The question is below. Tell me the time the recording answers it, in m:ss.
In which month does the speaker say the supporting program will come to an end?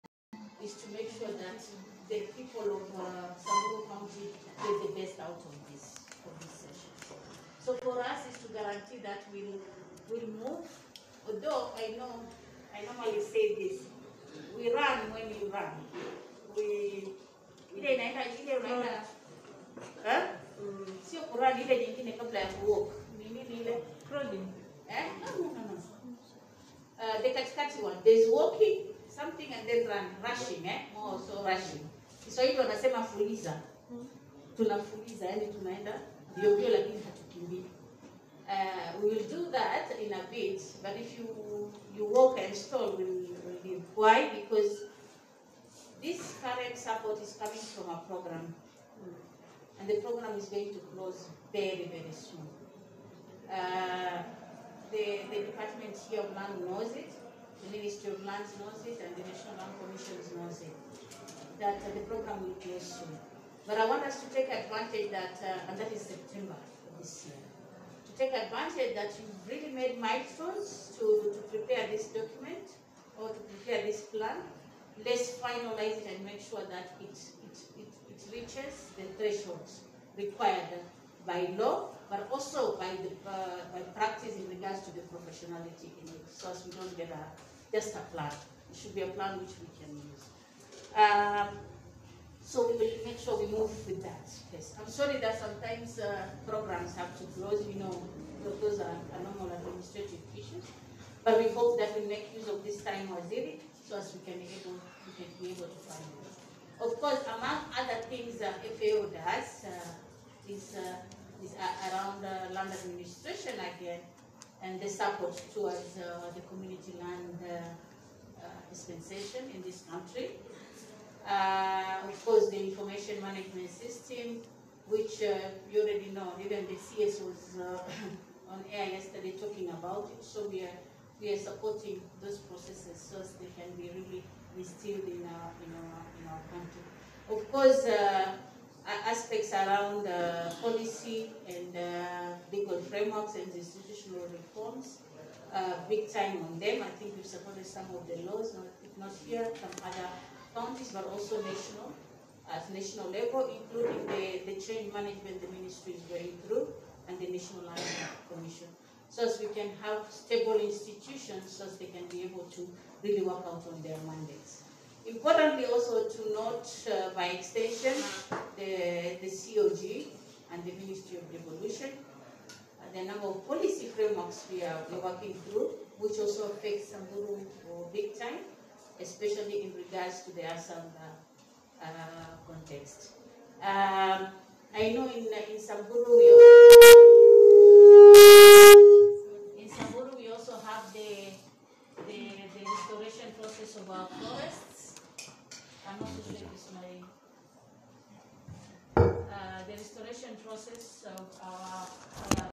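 1:06.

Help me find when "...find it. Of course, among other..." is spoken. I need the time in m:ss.
1:45.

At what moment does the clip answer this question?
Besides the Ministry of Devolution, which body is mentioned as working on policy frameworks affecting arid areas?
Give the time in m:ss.
2:49.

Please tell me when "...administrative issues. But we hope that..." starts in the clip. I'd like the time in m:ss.
1:39.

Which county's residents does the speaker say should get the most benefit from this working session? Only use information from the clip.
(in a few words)
Samburu County.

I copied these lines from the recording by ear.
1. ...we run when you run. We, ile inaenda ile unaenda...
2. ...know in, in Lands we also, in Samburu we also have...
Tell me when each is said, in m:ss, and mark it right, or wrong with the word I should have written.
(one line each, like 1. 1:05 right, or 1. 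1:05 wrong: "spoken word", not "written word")
1. 0:14 right
2. 3:04 wrong: "Samburu", not "Lands".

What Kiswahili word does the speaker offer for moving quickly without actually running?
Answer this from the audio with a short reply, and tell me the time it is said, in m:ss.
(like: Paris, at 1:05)
fuliza, at 0:33.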